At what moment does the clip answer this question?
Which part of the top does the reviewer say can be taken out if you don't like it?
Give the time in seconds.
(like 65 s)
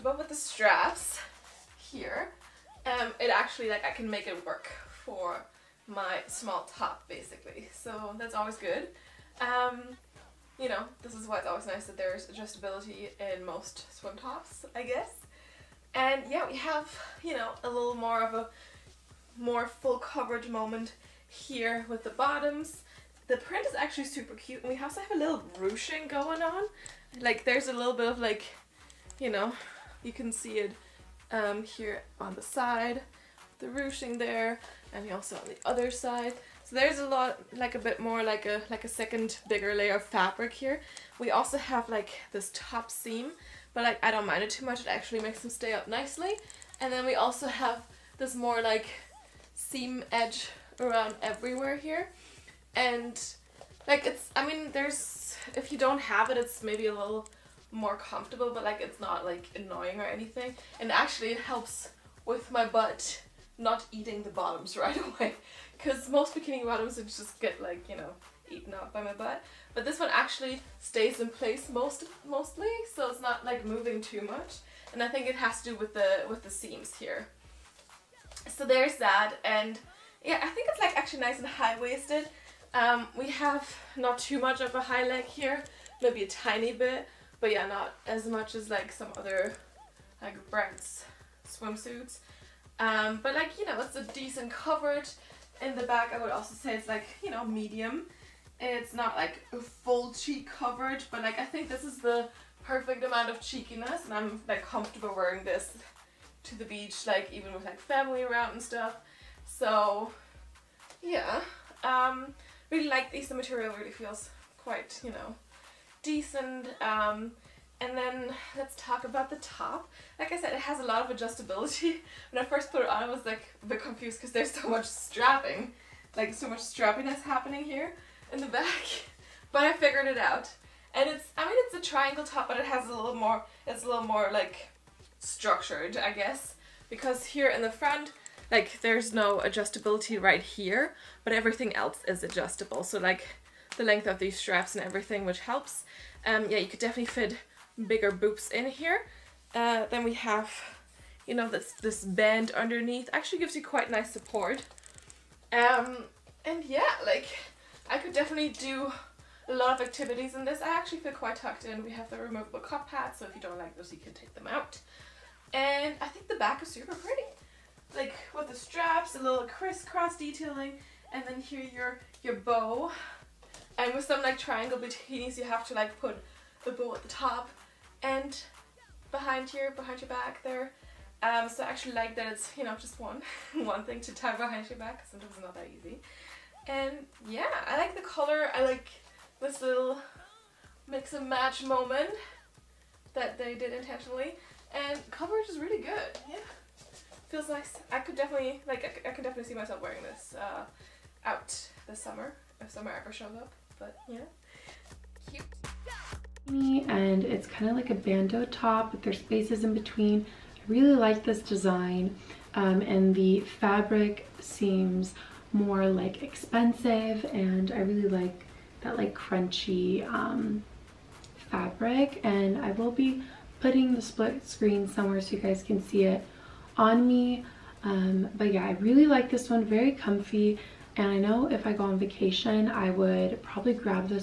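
162 s.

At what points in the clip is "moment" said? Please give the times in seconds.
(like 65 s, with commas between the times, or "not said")
20 s, 191 s.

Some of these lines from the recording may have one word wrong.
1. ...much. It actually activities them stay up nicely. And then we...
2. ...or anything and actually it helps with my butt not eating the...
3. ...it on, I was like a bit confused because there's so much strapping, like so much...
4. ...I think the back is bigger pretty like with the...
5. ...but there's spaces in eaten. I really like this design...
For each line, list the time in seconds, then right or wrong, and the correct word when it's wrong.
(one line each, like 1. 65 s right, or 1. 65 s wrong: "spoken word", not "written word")
1. 44 s wrong: "makes", not "activities"
2. 59 s right
3. 122 s right
4. 165 s wrong: "super", not "bigger"
5. 208 s wrong: "between", not "eaten".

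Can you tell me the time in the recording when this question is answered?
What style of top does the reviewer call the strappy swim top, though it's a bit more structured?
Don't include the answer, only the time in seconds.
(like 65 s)
131 s.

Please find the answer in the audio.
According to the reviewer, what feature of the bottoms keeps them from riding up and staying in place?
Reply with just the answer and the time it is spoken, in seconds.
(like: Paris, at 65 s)
The seams, at 76 s.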